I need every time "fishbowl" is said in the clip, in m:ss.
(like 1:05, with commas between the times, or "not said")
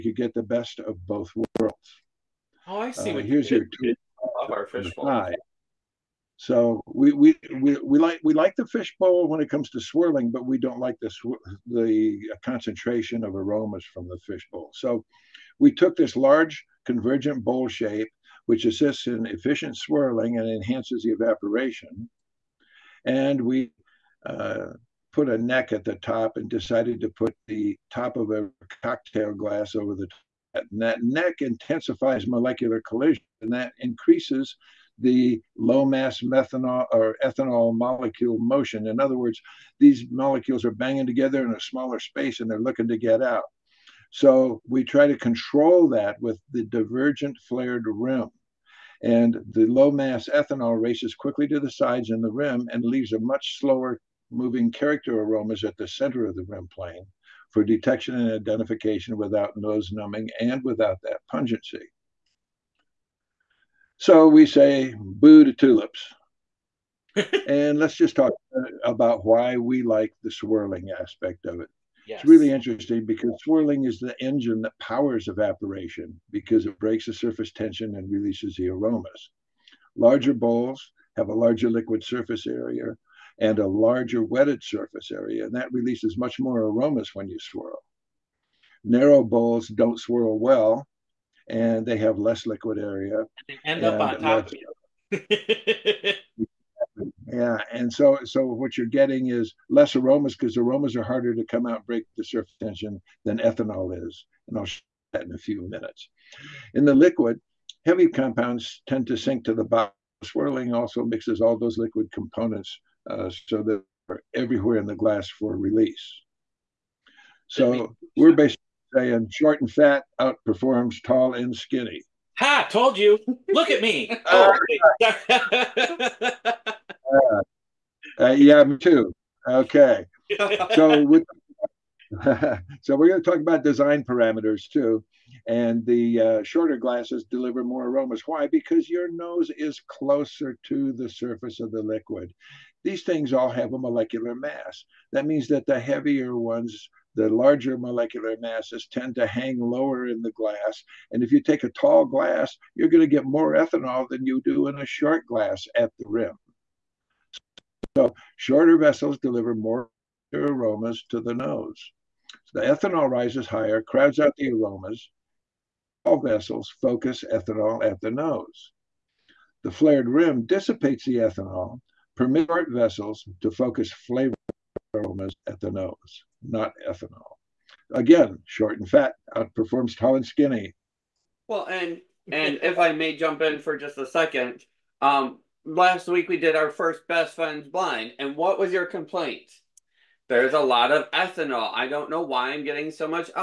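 0:04, 0:08, 0:14.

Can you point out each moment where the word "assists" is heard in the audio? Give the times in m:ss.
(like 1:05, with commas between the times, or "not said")
0:18.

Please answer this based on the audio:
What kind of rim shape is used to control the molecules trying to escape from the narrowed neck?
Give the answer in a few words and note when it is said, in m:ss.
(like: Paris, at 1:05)
Divergent flared rim, at 0:46.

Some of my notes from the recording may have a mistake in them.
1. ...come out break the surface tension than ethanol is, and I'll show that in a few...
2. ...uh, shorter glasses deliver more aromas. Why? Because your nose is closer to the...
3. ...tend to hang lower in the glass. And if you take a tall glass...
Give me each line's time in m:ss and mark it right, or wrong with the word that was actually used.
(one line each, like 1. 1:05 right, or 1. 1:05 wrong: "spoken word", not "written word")
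1. 1:41 right
2. 2:16 right
3. 2:28 right.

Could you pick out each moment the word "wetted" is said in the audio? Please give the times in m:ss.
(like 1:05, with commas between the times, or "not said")
1:24.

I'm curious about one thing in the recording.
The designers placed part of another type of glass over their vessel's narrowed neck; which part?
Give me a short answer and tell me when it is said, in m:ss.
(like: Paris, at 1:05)
Top of a cocktail glass, at 0:27.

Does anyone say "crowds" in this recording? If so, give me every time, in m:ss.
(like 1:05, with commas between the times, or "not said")
2:43.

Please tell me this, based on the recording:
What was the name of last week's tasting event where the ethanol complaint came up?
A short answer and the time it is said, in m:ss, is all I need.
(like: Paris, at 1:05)
Best friends blind, at 3:07.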